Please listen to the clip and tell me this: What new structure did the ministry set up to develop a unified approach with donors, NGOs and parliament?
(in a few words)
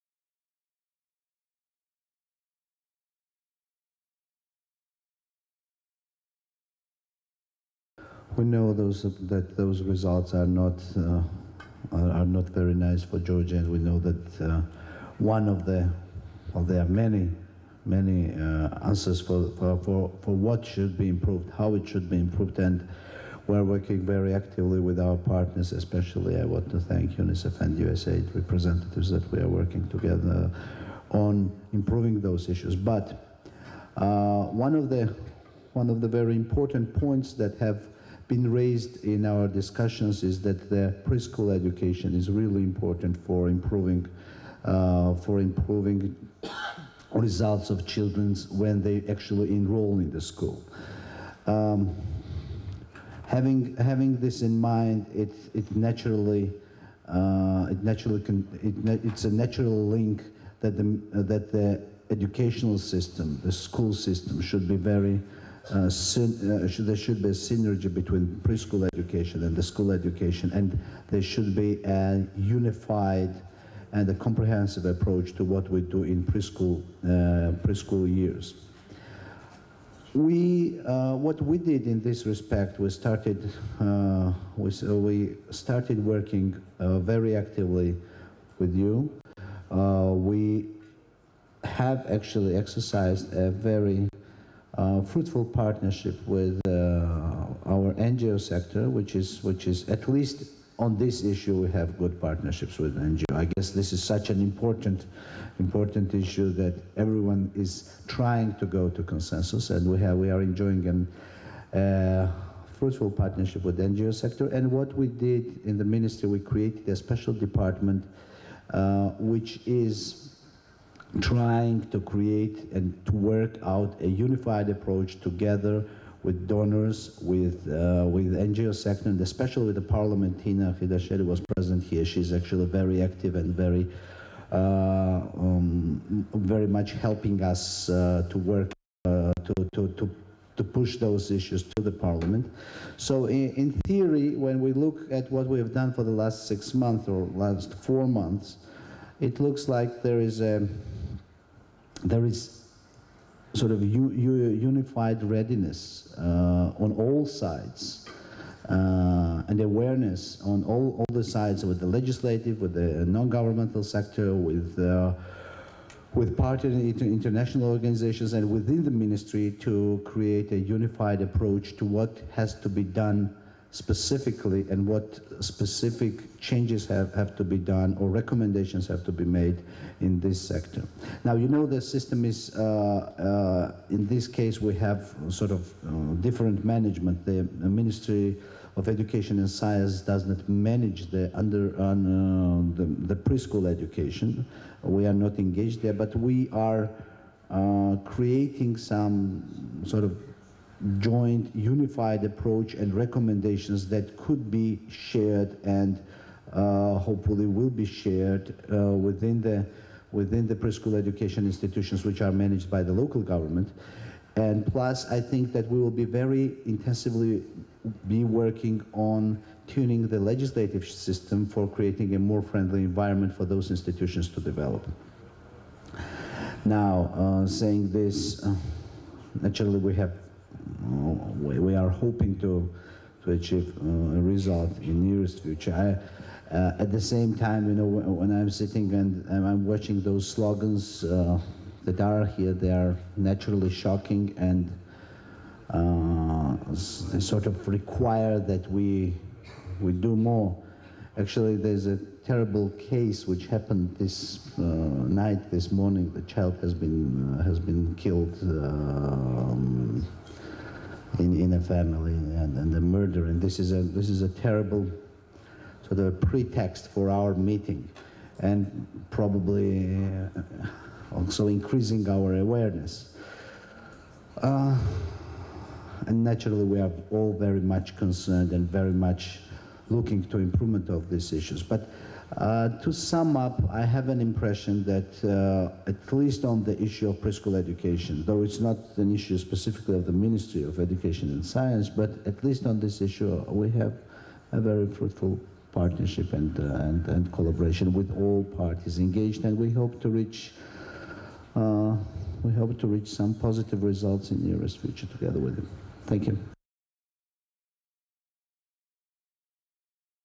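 a special department.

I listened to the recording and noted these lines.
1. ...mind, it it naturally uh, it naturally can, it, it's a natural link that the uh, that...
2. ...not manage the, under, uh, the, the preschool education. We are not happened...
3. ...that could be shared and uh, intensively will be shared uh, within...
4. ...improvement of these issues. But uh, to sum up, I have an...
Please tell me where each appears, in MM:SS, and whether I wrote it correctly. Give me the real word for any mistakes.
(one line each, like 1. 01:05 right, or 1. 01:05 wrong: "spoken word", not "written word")
1. 00:54 right
2. 03:10 wrong: "engaged", not "happened"
3. 03:23 wrong: "hopefully", not "intensively"
4. 04:40 right.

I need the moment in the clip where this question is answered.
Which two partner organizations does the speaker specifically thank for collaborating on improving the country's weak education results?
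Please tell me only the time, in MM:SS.
00:27.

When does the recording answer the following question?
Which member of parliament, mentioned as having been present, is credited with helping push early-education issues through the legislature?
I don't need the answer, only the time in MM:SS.
02:10.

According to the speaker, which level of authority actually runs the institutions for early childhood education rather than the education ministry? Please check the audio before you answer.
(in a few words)
local government.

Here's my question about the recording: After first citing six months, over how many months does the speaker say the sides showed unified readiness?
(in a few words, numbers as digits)
4 months.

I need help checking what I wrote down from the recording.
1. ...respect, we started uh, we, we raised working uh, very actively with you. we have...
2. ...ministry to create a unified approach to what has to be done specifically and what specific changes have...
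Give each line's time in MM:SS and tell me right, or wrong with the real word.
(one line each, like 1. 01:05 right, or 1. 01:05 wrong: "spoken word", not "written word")
1. 01:22 wrong: "started", not "raised"
2. 02:48 right.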